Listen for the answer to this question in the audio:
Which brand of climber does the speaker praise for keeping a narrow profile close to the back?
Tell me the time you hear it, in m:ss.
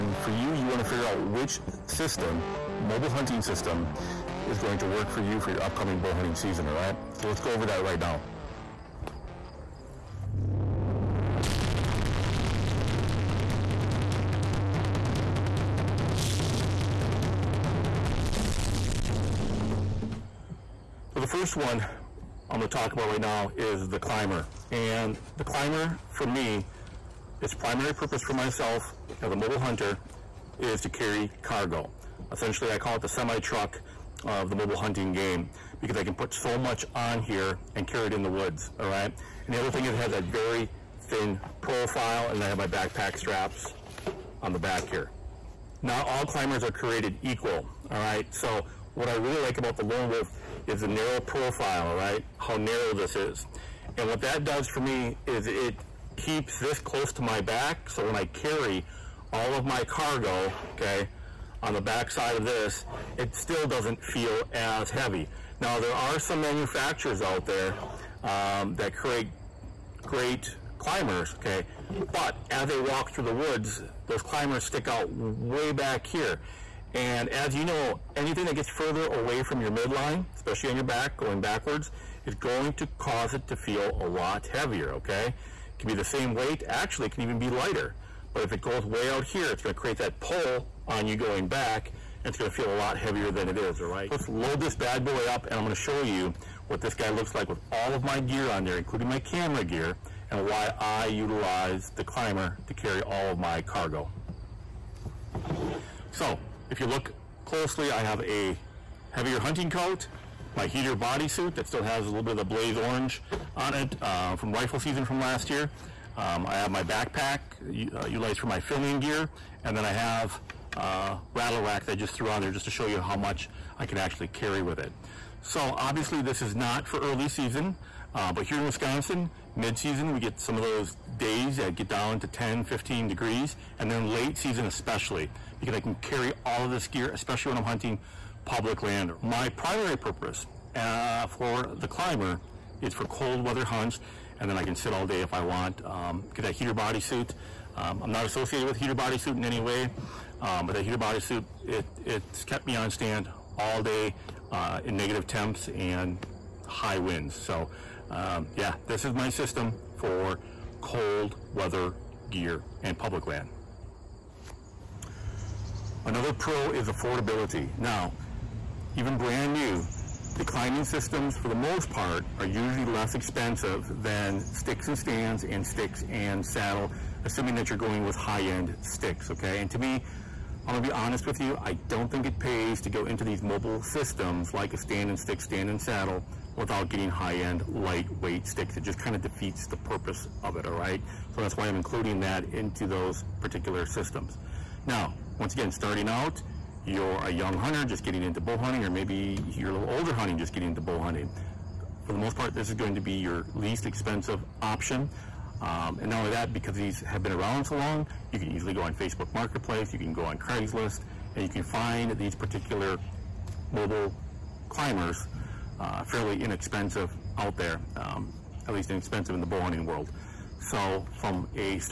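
0:49.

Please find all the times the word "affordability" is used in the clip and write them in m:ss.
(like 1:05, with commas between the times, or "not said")
2:46.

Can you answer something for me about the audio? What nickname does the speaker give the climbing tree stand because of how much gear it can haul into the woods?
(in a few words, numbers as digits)
Semi-truck.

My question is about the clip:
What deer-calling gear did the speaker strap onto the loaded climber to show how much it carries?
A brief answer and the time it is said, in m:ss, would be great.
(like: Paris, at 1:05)
Rattle rack, at 2:01.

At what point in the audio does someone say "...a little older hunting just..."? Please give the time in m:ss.
3:19.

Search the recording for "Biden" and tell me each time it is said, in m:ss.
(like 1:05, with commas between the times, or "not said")
not said.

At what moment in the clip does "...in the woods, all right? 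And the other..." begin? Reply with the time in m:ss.
0:38.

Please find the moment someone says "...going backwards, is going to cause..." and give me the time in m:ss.
1:21.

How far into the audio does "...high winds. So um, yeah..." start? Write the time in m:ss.
2:36.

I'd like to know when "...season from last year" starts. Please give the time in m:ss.
1:54.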